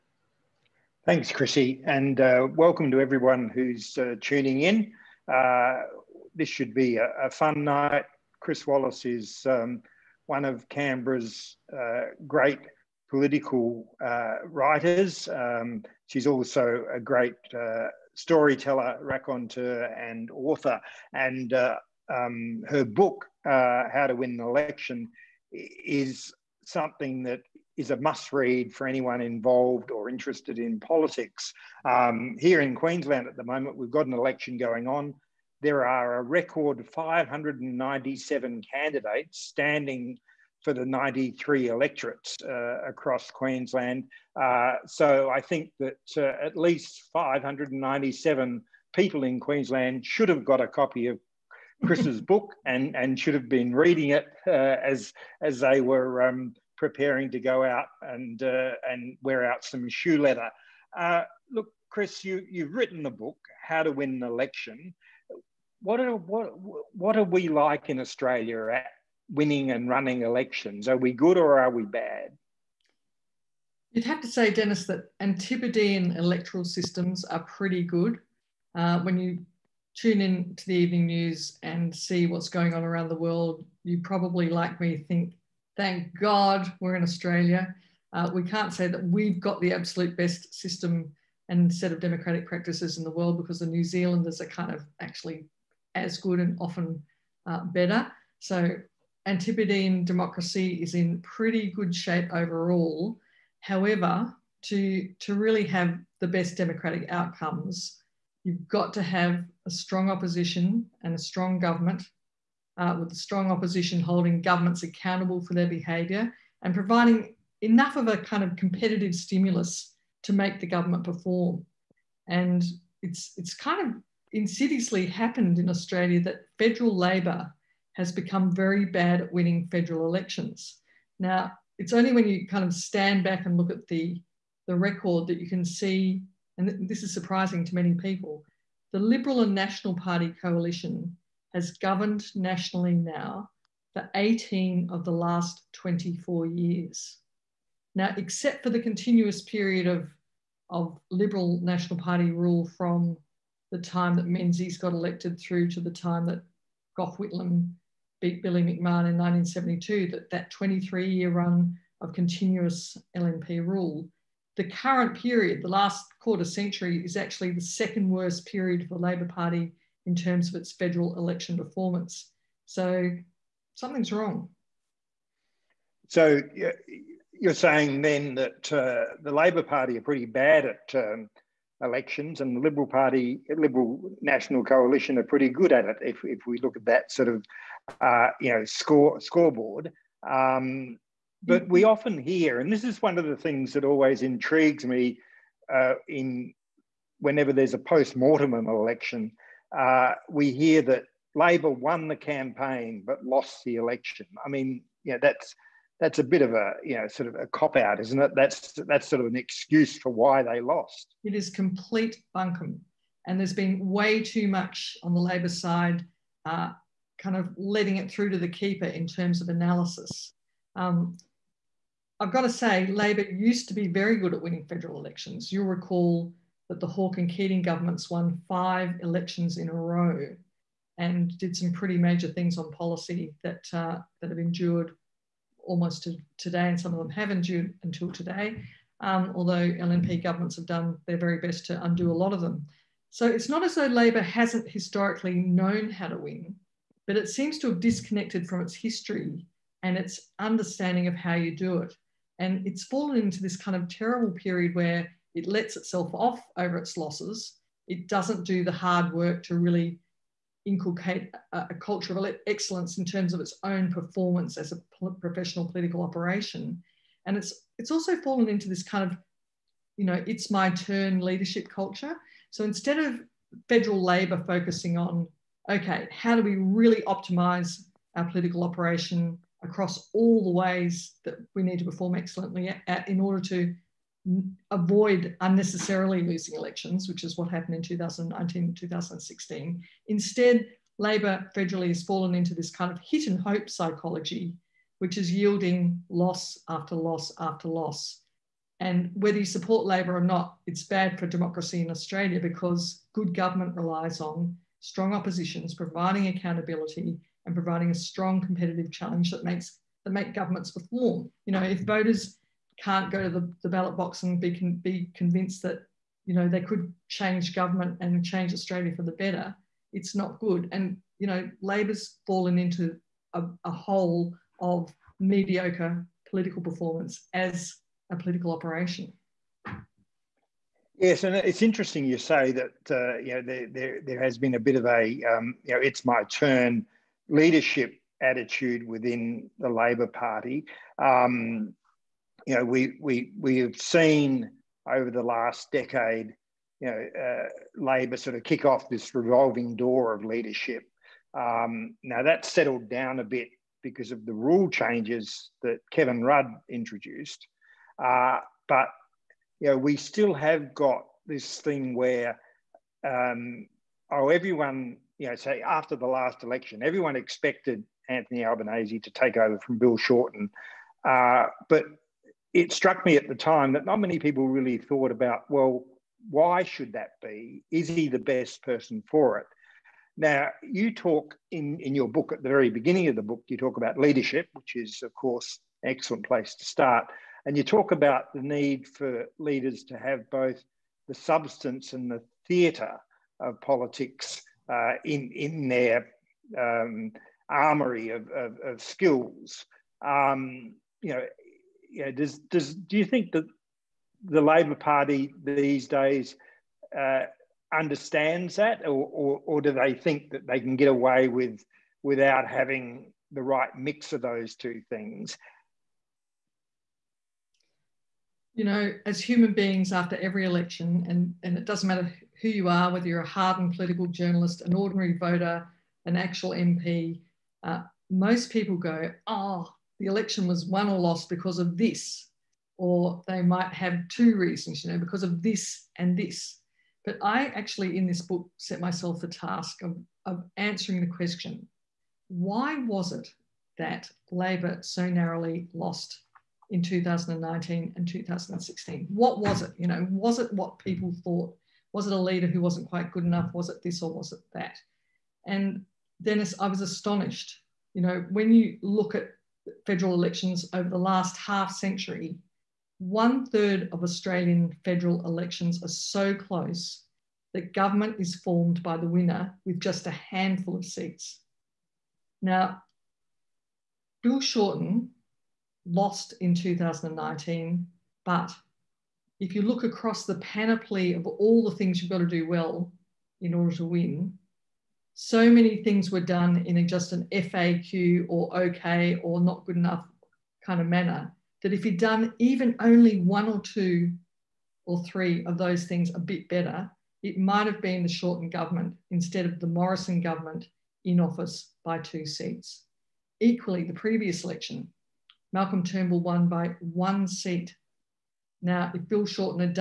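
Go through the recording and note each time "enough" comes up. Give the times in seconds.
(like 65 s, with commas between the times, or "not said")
117 s, 453 s, 489 s.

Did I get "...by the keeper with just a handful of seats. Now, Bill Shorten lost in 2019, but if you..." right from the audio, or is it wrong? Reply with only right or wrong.
wrong.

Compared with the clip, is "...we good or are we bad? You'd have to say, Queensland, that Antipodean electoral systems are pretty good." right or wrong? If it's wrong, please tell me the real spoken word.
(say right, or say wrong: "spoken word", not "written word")
wrong: "Dennis", not "Queensland".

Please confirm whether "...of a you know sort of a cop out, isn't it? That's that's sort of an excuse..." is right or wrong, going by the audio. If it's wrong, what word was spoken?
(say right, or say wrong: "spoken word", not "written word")
right.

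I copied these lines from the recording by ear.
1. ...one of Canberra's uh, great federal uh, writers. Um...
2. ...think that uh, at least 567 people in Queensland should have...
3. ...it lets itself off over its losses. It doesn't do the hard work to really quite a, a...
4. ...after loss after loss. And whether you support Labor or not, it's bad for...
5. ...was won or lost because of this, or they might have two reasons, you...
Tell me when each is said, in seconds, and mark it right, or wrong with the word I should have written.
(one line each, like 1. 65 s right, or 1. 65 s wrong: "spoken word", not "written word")
1. 10 s wrong: "political", not "federal"
2. 45 s wrong: "597", not "567"
3. 255 s wrong: "inculcate", not "quite"
4. 296 s right
5. 430 s right.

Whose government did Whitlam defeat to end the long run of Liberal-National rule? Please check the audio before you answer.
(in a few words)
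Billy McMahon.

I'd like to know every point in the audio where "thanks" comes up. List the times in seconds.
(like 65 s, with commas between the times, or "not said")
1 s, 85 s.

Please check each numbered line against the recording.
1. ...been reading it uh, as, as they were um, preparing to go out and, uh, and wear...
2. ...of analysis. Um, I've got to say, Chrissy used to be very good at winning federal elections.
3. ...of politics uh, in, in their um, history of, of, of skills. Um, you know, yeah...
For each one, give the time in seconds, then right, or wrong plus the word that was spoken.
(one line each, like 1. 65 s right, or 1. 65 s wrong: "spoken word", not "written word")
1. 53 s right
2. 219 s wrong: "Labor", not "Chrissy"
3. 393 s wrong: "armory", not "history".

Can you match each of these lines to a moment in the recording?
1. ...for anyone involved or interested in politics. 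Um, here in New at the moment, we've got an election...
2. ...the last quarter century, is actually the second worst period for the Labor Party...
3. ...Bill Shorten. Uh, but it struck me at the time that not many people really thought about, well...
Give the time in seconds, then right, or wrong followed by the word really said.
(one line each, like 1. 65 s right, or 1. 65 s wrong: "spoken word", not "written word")
1. 28 s wrong: "Queensland", not "New"
2. 165 s right
3. 369 s right.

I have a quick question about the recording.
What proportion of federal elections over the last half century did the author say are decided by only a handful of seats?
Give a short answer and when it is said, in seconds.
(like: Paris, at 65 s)
one third, at 462 s.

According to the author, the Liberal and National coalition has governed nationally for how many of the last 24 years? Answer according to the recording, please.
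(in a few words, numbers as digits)
18.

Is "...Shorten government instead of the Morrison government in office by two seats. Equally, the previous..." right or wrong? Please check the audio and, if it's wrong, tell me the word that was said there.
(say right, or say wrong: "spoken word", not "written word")
right.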